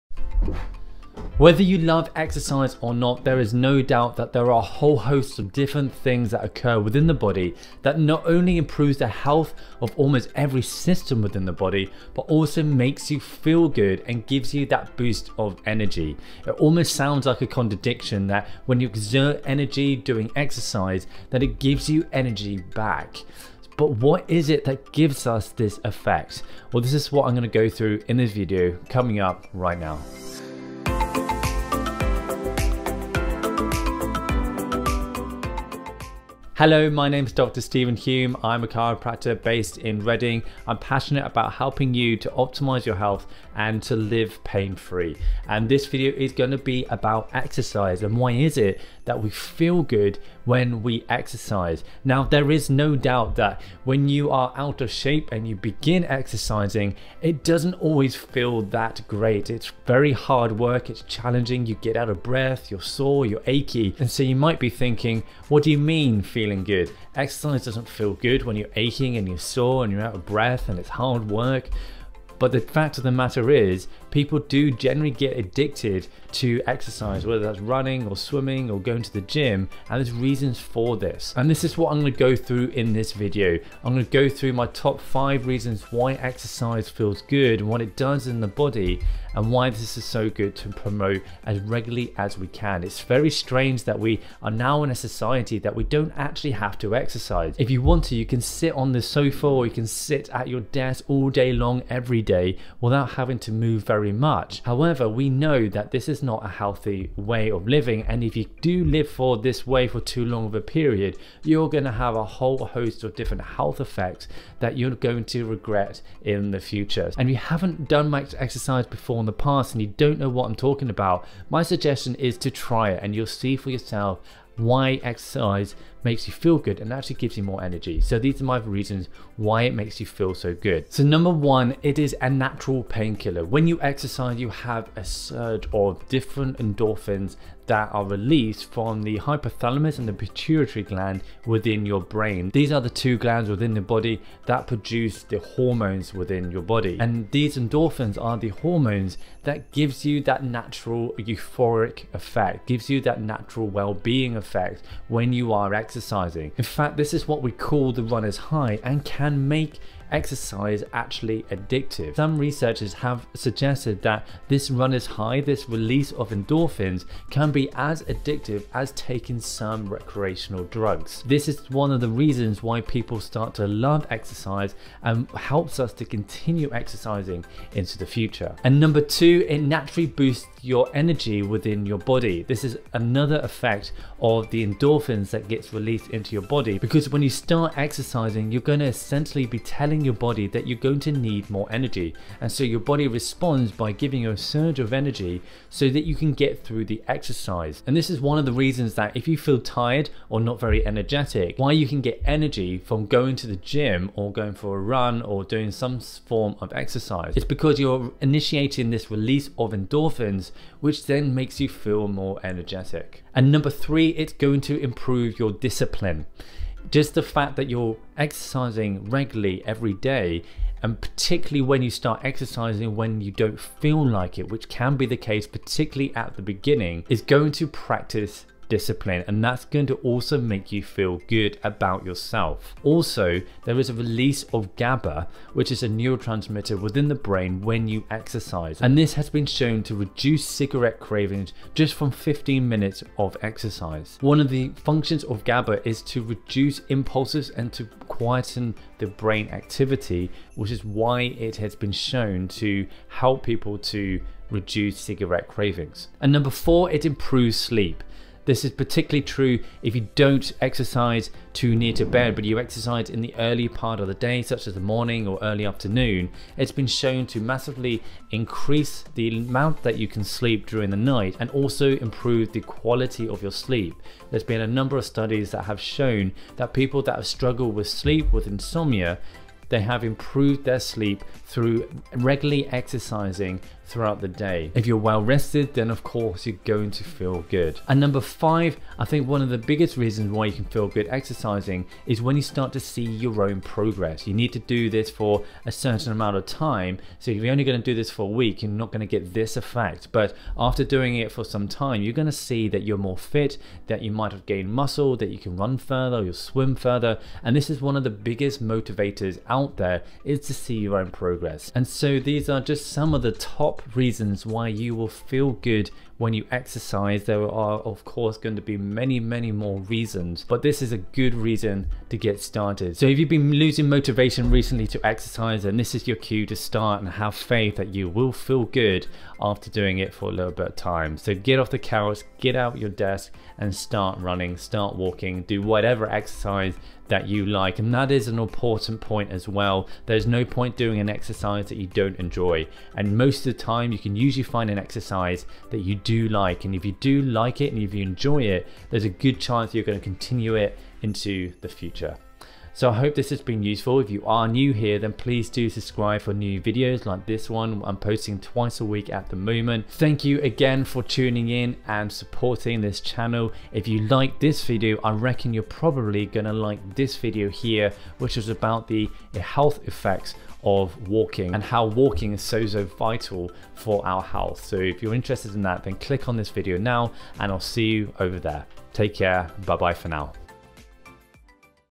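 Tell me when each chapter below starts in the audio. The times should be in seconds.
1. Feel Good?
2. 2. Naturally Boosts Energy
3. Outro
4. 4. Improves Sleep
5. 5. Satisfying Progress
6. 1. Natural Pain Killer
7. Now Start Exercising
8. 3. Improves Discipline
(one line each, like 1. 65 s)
1. 52 s
2. 178 s
3. 352 s
4. 256 s
5. 287 s
6. 130 s
7. 314 s
8. 213 s.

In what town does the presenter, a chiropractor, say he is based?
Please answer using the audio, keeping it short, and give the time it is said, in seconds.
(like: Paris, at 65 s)
Reading, at 40 s.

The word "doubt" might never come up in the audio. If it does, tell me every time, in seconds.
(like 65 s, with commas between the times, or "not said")
3 s, 52 s.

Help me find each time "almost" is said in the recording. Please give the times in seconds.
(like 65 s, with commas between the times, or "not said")
9 s, 16 s.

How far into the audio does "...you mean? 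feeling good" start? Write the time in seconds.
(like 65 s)
65 s.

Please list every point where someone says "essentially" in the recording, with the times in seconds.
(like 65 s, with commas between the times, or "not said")
188 s.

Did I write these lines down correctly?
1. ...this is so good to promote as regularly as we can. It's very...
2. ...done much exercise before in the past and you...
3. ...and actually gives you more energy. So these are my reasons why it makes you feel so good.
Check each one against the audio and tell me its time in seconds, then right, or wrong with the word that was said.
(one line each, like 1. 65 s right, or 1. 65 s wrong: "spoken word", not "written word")
1. 89 s right
2. 117 s right
3. 126 s right.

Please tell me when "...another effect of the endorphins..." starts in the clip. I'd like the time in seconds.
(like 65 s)
182 s.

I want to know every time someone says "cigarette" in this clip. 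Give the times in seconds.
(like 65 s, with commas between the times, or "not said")
240 s, 254 s.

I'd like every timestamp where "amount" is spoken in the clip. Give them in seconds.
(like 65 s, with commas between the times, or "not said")
269 s, 296 s.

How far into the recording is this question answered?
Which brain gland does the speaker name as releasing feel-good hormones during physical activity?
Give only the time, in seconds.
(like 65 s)
139 s.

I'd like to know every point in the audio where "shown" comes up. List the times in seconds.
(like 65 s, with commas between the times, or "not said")
239 s, 251 s, 266 s, 275 s.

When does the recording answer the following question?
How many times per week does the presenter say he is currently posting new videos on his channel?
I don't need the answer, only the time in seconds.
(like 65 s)
358 s.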